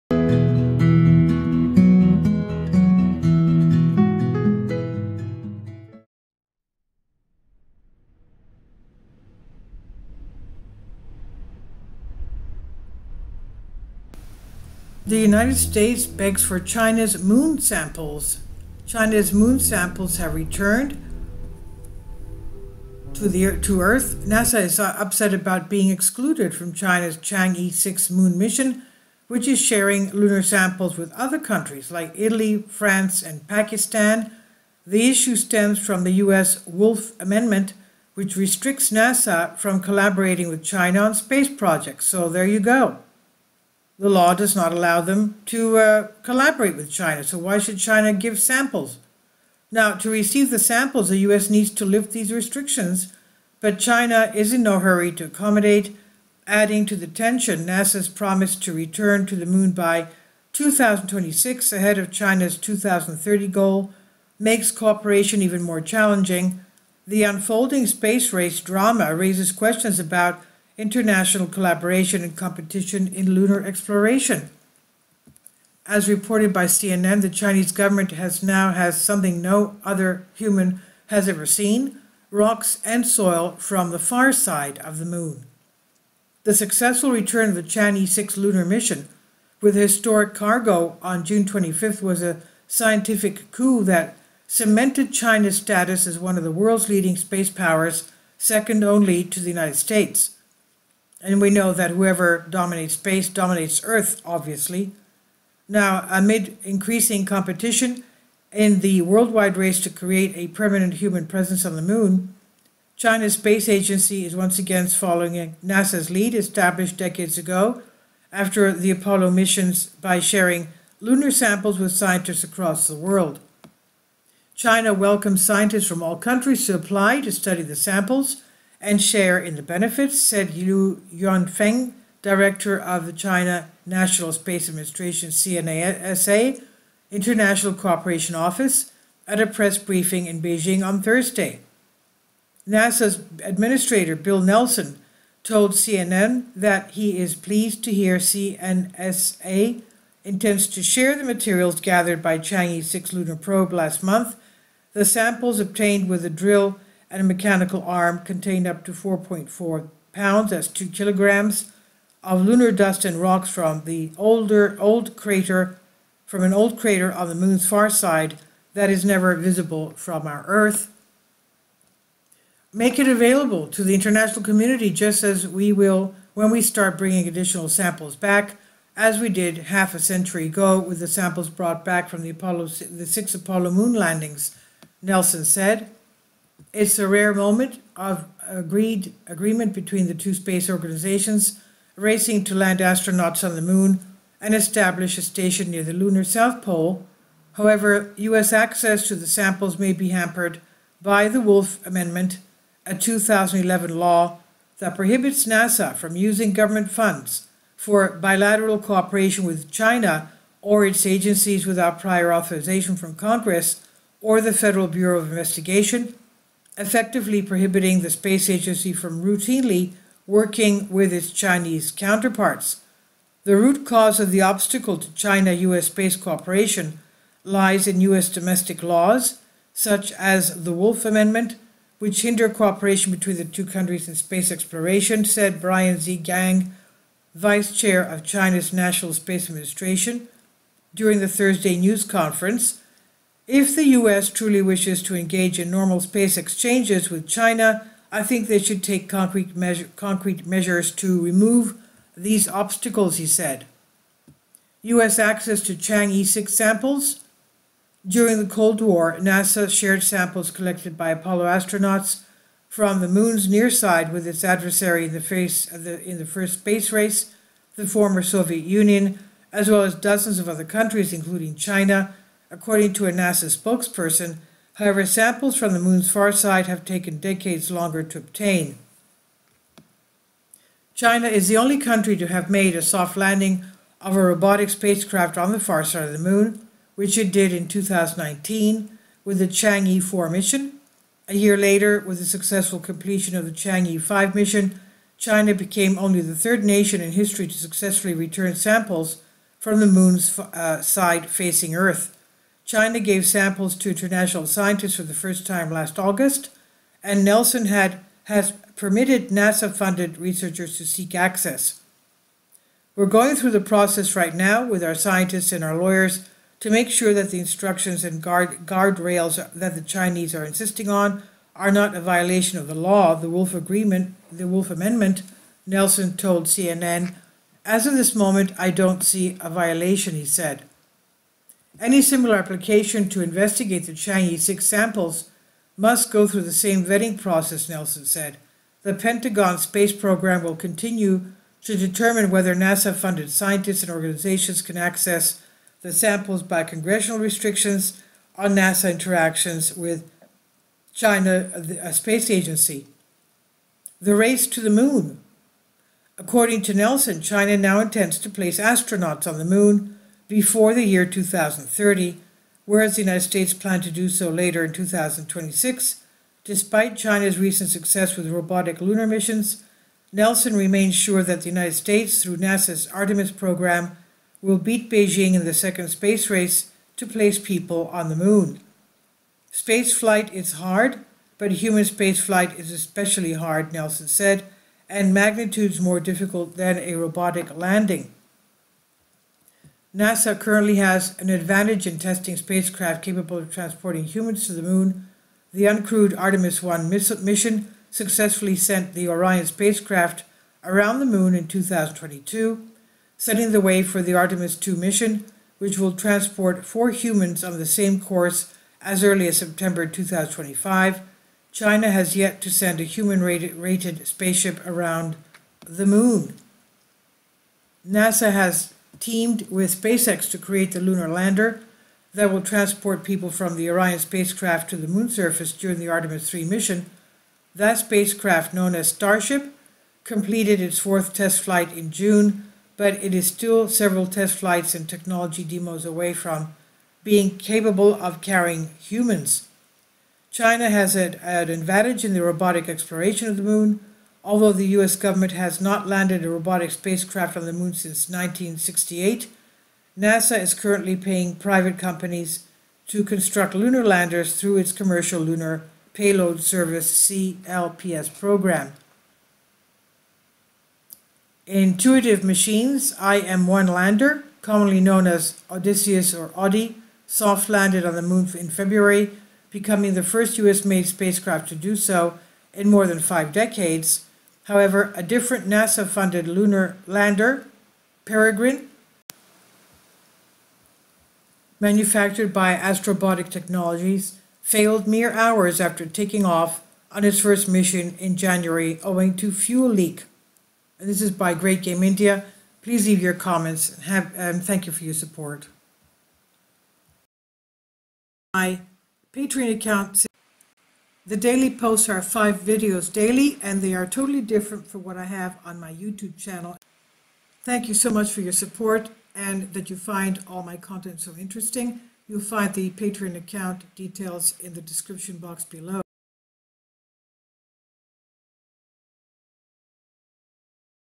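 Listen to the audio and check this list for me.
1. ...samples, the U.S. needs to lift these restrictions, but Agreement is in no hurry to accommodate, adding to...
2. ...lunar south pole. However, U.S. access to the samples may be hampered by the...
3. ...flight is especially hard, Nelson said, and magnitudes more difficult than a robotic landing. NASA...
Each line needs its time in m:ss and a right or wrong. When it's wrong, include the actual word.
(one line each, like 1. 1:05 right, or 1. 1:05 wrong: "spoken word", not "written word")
1. 0:50 wrong: "China", not "Agreement"
2. 3:15 right
3. 6:22 right.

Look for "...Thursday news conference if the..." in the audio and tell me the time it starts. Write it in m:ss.
4:01.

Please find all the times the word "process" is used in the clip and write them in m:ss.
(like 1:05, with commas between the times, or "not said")
5:13, 5:37.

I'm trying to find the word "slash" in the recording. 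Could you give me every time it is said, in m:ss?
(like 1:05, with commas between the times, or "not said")
not said.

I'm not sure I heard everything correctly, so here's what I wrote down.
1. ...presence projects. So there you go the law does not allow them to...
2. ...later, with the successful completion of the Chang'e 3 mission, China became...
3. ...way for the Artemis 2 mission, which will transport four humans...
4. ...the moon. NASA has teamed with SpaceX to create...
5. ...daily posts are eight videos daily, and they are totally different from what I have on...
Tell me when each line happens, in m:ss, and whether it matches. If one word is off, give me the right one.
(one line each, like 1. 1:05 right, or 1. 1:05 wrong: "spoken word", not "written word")
1. 0:41 wrong: "space", not "presence"
2. 4:51 wrong: "5", not "3"
3. 6:43 right
4. 6:55 right
5. 8:21 wrong: "five", not "eight".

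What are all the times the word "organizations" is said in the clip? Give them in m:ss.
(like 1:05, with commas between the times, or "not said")
3:10, 5:43.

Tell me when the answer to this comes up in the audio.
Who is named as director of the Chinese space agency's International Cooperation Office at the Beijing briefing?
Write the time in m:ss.
2:10.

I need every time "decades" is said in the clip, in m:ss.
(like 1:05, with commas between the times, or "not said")
1:56, 4:37, 7:53.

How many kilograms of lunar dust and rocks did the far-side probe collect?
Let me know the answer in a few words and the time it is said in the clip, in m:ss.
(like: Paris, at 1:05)
2 kilograms, at 2:40.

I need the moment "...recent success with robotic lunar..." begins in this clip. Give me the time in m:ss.
6:07.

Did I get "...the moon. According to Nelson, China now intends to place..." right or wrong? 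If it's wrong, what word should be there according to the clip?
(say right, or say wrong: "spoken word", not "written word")
right.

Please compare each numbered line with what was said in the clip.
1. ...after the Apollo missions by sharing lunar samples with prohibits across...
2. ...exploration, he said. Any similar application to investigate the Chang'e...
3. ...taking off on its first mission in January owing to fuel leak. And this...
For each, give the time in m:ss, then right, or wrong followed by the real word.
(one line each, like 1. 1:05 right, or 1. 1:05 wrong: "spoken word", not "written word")
1. 1:58 wrong: "scientists", not "prohibits"
2. 5:29 wrong: "violation", not "exploration"
3. 8:05 right.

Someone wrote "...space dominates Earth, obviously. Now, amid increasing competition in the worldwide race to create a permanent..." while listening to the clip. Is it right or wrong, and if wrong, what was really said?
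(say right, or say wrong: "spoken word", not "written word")
right.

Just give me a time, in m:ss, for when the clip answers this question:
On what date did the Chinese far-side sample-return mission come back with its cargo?
1:31.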